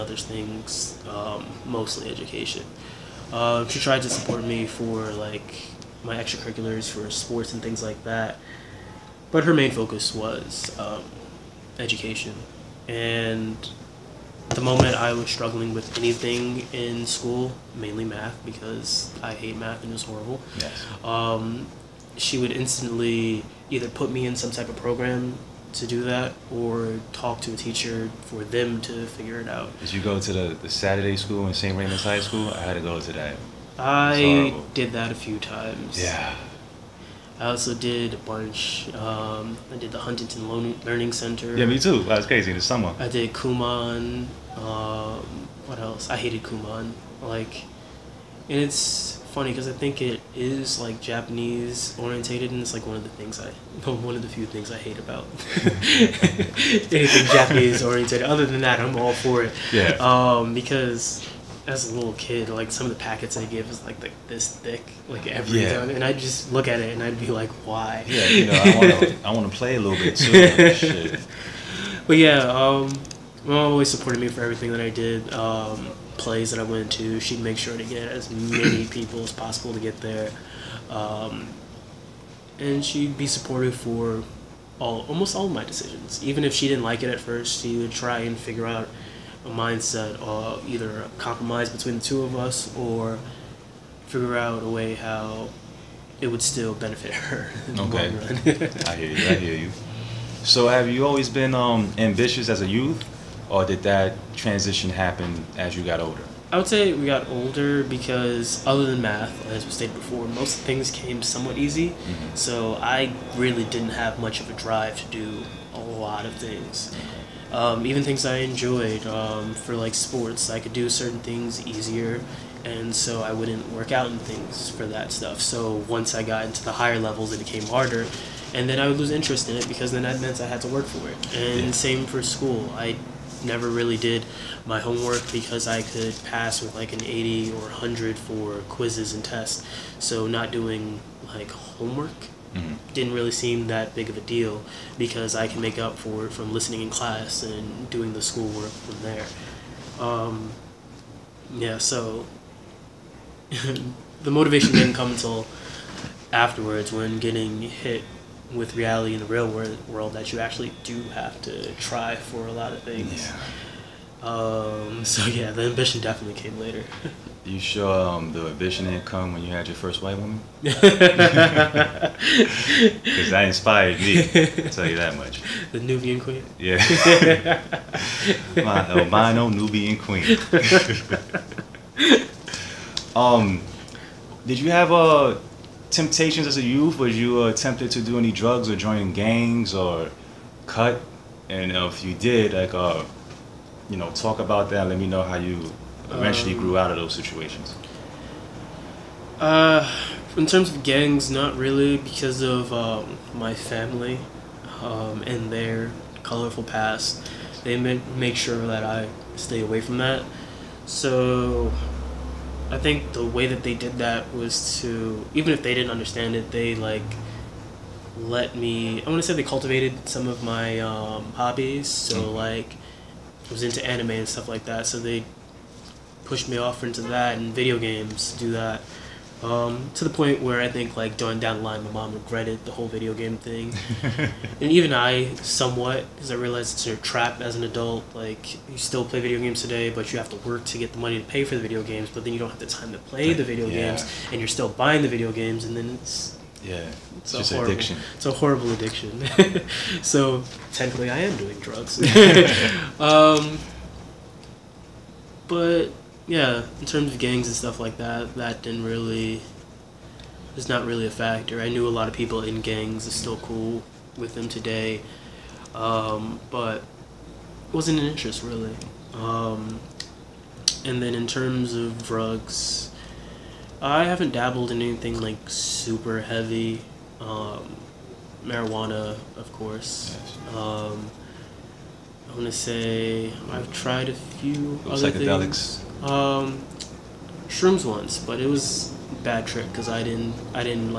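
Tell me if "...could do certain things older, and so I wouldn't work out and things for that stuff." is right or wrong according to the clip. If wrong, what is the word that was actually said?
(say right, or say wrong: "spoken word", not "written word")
wrong: "easier", not "older".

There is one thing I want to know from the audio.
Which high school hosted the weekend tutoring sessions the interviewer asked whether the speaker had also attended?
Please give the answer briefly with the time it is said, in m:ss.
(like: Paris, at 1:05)
St. Raymond's High School, at 0:31.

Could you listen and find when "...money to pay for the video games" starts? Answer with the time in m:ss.
4:00.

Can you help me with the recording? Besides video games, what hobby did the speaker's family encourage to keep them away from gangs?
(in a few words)
anime.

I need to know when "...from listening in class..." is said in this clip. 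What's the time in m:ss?
2:26.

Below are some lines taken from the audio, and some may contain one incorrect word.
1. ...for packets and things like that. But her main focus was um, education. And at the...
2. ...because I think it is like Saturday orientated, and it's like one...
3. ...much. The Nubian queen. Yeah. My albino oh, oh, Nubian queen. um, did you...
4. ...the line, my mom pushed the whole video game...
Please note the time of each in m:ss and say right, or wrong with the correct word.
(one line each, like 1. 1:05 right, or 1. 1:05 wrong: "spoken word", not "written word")
1. 0:06 wrong: "sports", not "packets"
2. 0:49 wrong: "Japanese", not "Saturday"
3. 2:55 right
4. 3:51 wrong: "regretted", not "pushed".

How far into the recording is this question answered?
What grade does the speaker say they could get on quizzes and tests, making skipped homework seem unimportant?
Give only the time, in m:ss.
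2:17.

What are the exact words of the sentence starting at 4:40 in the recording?
i Um, I want to say I've tried a few other psychedelics.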